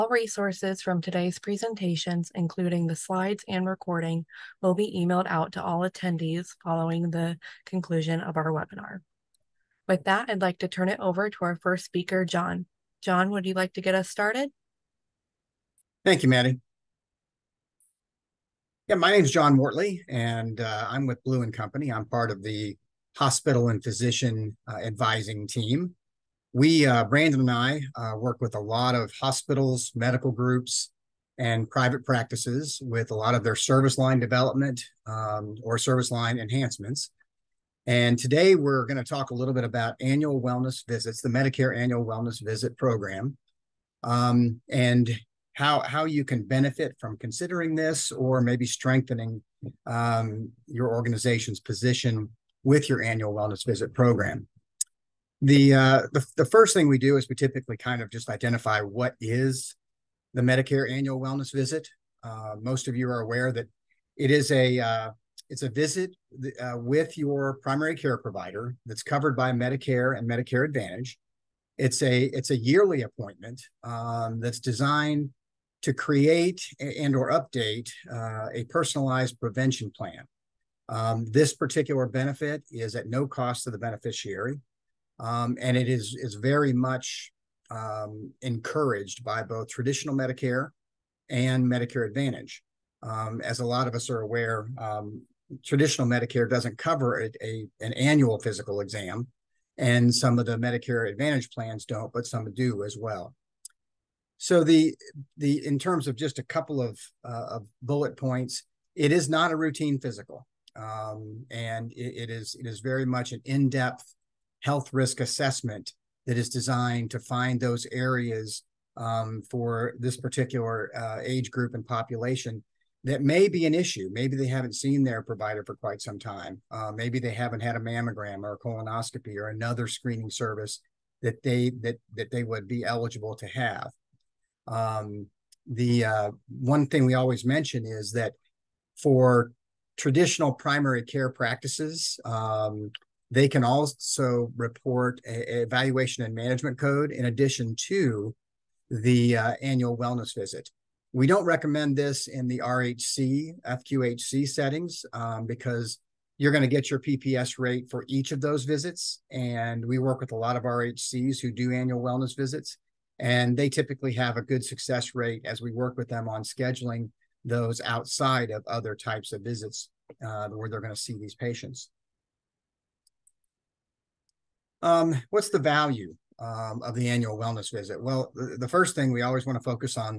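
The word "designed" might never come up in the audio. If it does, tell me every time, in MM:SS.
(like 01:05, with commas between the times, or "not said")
01:14, 01:56.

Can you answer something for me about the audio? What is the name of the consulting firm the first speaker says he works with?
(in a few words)
Blue and Company.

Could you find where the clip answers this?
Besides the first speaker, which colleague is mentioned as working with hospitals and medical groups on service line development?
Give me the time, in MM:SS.
00:27.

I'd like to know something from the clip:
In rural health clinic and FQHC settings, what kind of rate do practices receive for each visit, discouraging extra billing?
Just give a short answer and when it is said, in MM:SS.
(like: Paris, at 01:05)
PPS rate, at 02:36.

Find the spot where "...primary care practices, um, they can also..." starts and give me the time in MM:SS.
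02:20.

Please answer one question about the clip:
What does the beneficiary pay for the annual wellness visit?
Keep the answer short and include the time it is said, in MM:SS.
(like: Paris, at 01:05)
No cost, at 01:23.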